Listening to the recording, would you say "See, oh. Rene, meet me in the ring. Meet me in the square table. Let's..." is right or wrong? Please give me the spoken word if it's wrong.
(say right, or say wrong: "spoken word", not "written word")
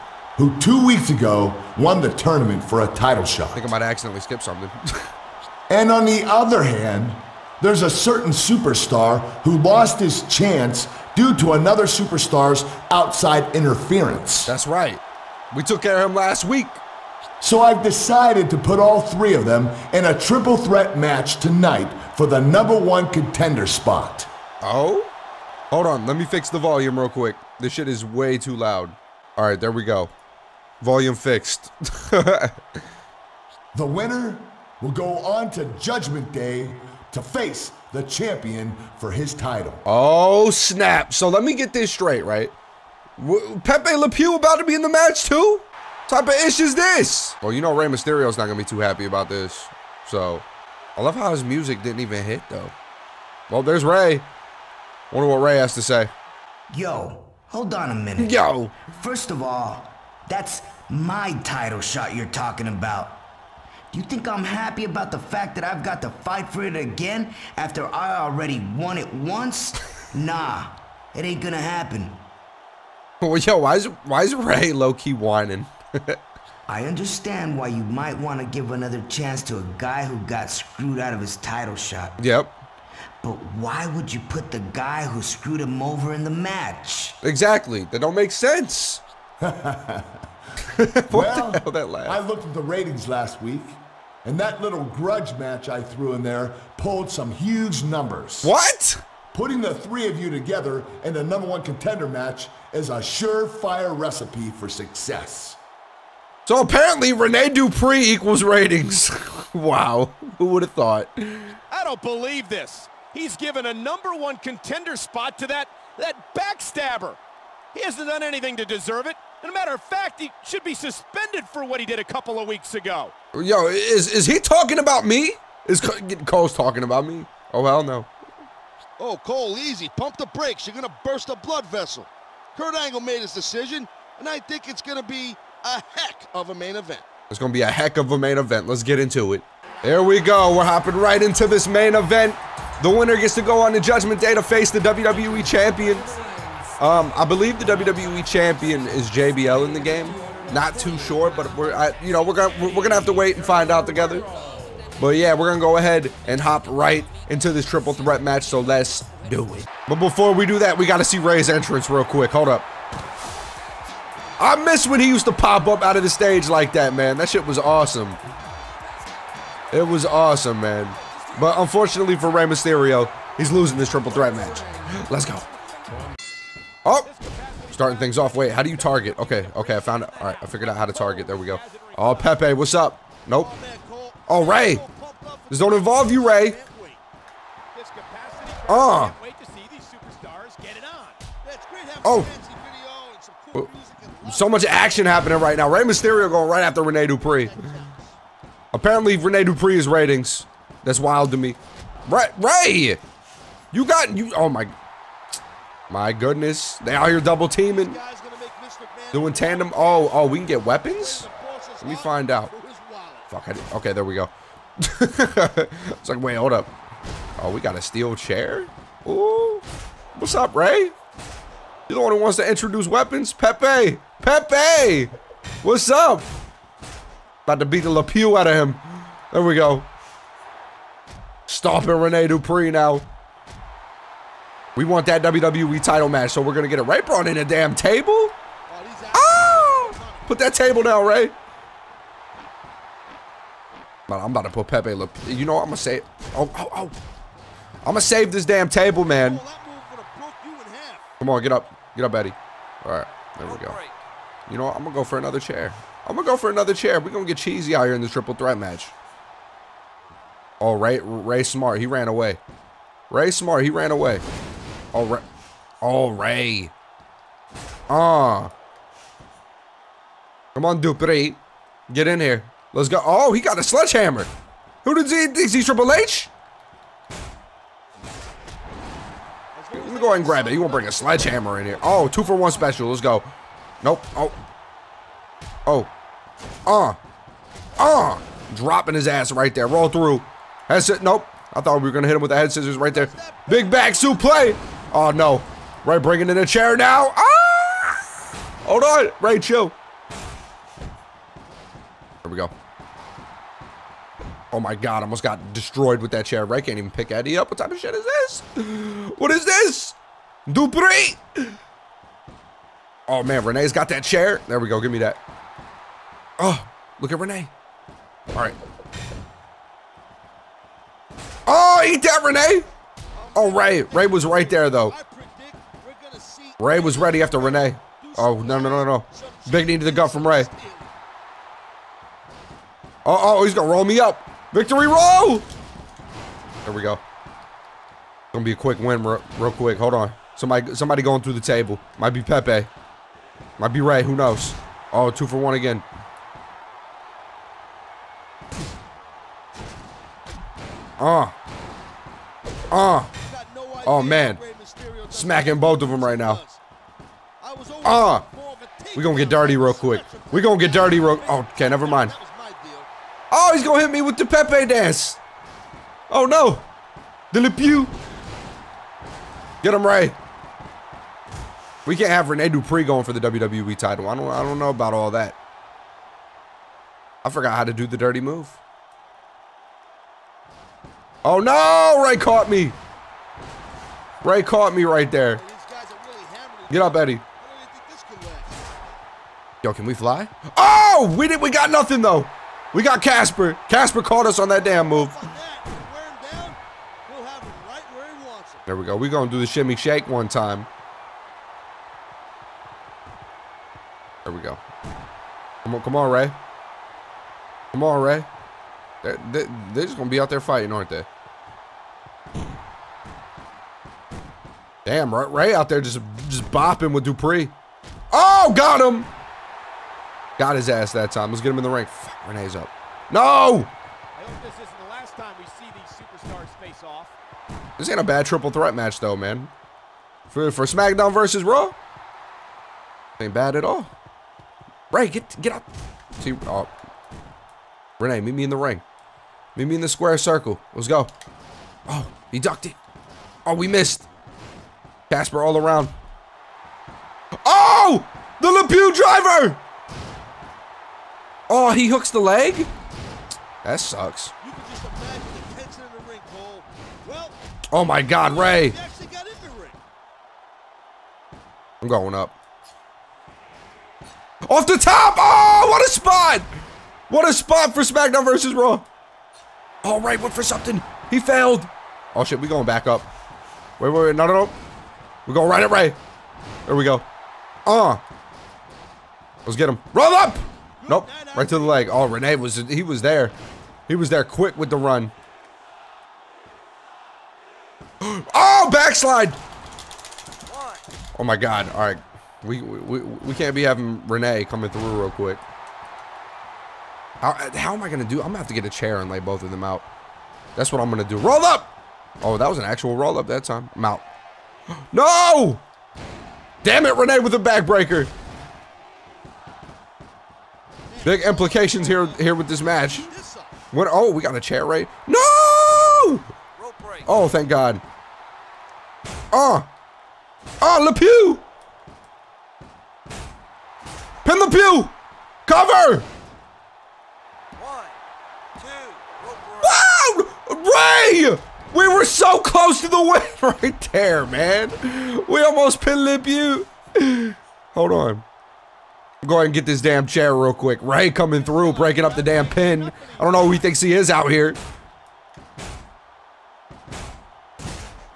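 wrong: "circle", not "table".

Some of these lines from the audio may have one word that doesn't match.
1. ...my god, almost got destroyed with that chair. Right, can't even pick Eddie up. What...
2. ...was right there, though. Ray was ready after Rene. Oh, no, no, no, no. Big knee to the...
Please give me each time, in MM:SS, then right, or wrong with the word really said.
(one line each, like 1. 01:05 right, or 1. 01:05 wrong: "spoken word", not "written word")
1. 05:04 right
2. 05:24 right.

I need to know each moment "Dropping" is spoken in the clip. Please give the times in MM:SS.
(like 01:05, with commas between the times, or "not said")
04:48.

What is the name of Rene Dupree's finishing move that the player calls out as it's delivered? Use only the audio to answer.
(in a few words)
The Lepew driver.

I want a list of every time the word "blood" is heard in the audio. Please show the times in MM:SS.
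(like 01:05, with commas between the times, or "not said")
02:11.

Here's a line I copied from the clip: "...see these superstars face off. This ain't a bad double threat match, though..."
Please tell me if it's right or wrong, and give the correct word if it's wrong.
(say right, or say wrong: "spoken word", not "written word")
wrong: "triple", not "double".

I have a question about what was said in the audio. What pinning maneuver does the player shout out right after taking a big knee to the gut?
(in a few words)
Victory roll.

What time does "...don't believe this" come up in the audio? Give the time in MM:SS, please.
01:51.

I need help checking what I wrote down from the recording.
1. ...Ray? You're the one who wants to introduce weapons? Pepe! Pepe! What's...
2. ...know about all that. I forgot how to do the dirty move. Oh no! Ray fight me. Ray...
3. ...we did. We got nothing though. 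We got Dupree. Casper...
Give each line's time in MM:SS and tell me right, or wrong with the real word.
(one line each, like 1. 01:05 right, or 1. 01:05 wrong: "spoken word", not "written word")
1. 03:40 right
2. 06:14 wrong: "caught", not "fight"
3. 06:31 wrong: "Casper", not "Dupree".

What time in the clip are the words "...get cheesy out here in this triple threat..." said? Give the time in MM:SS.
04:17.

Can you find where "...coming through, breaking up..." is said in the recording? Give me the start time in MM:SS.
09:01.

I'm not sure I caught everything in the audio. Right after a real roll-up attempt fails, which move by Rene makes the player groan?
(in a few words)
backbreaker.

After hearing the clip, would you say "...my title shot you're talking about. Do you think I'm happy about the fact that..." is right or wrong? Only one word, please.
right.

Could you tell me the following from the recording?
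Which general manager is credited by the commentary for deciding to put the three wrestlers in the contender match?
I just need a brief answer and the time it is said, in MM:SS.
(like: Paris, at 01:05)
Kurt Angle, at 02:12.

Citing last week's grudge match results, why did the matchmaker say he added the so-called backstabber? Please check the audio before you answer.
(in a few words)
huge numbers.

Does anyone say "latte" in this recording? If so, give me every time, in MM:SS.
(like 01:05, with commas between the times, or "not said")
not said.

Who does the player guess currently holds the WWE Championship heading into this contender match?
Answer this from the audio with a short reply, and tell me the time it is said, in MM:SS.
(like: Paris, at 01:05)
JBL, at 02:29.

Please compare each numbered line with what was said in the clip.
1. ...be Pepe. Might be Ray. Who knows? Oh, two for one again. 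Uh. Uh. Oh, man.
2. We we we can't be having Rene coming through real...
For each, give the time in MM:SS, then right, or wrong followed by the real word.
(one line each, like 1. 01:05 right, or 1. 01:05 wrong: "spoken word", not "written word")
1. 05:42 right
2. 08:12 right.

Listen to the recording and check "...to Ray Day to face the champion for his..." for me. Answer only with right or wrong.
wrong.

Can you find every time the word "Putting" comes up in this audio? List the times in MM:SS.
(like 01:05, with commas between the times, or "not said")
01:39.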